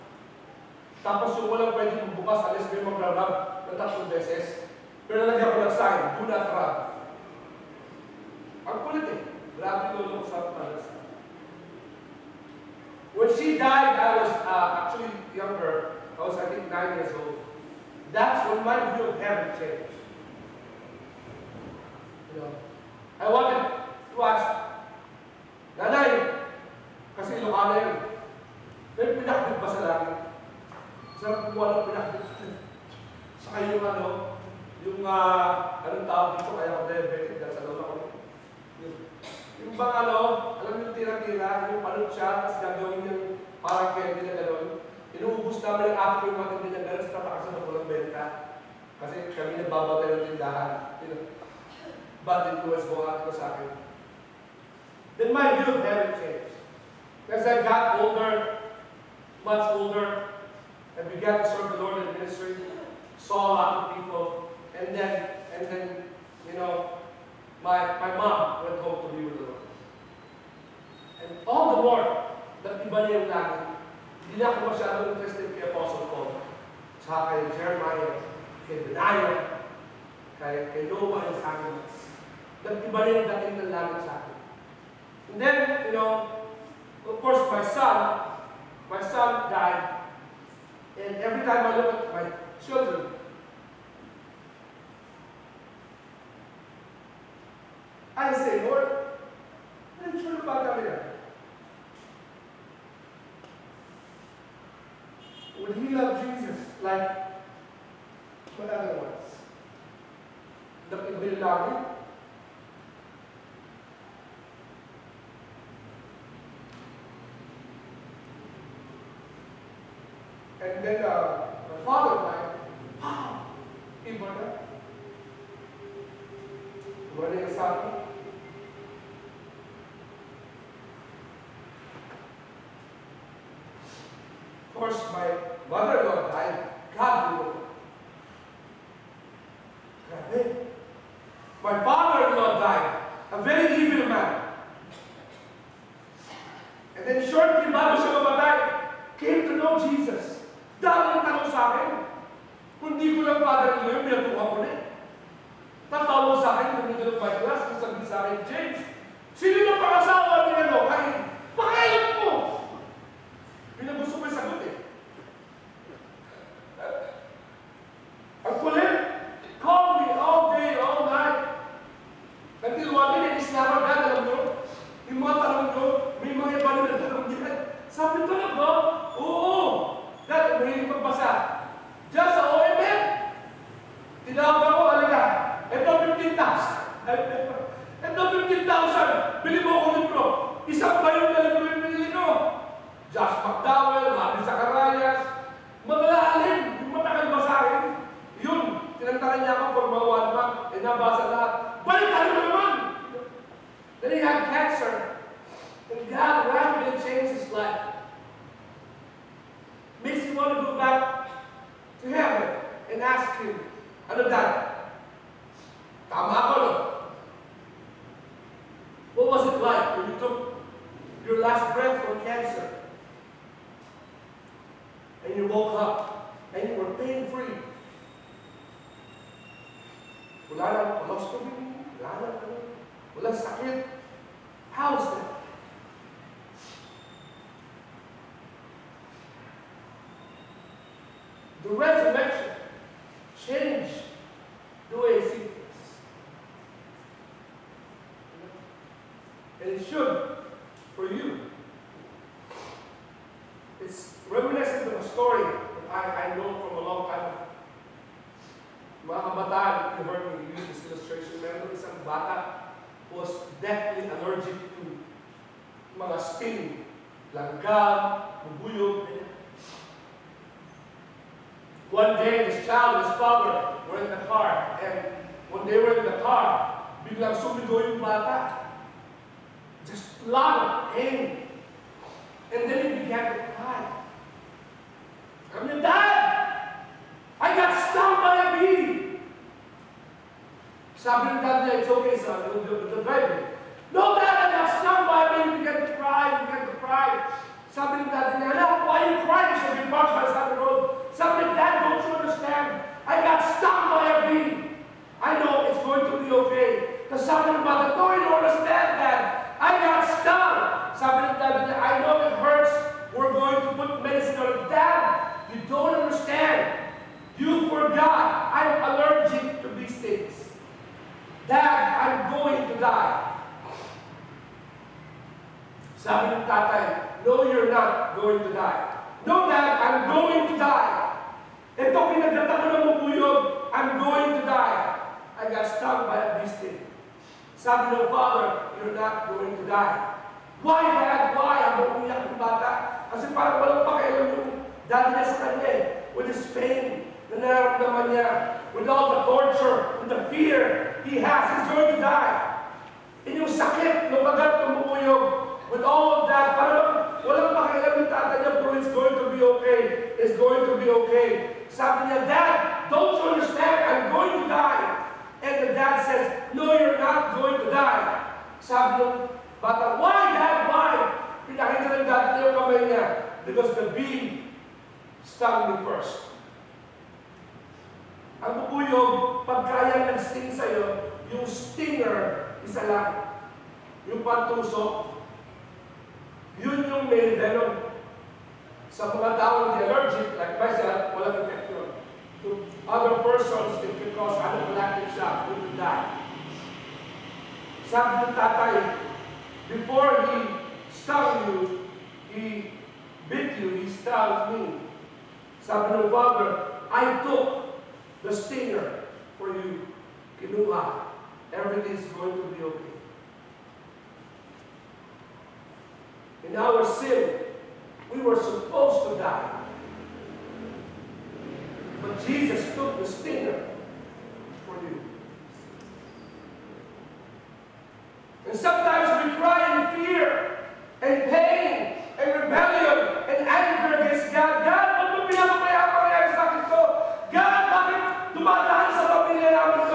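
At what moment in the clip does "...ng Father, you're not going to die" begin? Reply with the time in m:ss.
5:37.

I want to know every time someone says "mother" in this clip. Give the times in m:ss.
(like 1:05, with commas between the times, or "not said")
2:15, 5:07.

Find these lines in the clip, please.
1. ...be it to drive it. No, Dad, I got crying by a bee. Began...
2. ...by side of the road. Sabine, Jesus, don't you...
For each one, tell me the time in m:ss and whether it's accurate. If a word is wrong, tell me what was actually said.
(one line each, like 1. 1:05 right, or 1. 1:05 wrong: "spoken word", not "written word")
1. 4:52 wrong: "stung", not "crying"
2. 5:00 wrong: "Dad", not "Jesus".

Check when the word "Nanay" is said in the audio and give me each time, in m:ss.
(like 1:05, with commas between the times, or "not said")
0:25.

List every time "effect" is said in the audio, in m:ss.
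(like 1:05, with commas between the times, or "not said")
6:31.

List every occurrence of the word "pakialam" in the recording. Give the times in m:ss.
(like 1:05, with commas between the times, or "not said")
5:43, 5:57.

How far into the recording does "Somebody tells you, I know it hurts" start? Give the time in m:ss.
5:10.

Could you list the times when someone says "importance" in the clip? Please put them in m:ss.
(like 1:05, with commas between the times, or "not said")
not said.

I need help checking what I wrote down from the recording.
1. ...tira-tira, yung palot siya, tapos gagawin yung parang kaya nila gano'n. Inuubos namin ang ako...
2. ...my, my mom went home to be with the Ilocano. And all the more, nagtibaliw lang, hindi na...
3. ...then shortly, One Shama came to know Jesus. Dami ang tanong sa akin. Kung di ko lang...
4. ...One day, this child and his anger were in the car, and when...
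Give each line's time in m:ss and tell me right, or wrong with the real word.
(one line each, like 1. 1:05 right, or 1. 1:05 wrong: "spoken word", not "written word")
1. 0:40 right
2. 1:07 wrong: "Lord", not "Ilocano"
3. 2:27 wrong: "Baba", not "One"
4. 4:31 wrong: "father", not "anger".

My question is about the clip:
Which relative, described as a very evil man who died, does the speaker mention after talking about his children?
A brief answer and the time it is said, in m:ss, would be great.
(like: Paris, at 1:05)
father-in-law, at 2:21.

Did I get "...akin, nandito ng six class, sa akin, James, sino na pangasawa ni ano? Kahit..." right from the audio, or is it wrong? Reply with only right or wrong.
wrong.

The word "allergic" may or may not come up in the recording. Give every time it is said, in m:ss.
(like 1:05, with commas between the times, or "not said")
4:24, 5:18, 6:29.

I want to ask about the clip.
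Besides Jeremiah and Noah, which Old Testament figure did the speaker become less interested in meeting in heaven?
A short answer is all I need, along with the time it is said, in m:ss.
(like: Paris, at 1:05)
Benaiah, at 1:18.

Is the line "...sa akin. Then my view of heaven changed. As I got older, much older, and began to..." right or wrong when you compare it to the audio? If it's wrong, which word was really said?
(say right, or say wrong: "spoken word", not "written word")
right.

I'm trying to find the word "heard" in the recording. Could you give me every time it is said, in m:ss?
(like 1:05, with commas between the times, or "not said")
4:20.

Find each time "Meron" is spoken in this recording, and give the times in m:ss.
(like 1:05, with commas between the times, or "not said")
4:21.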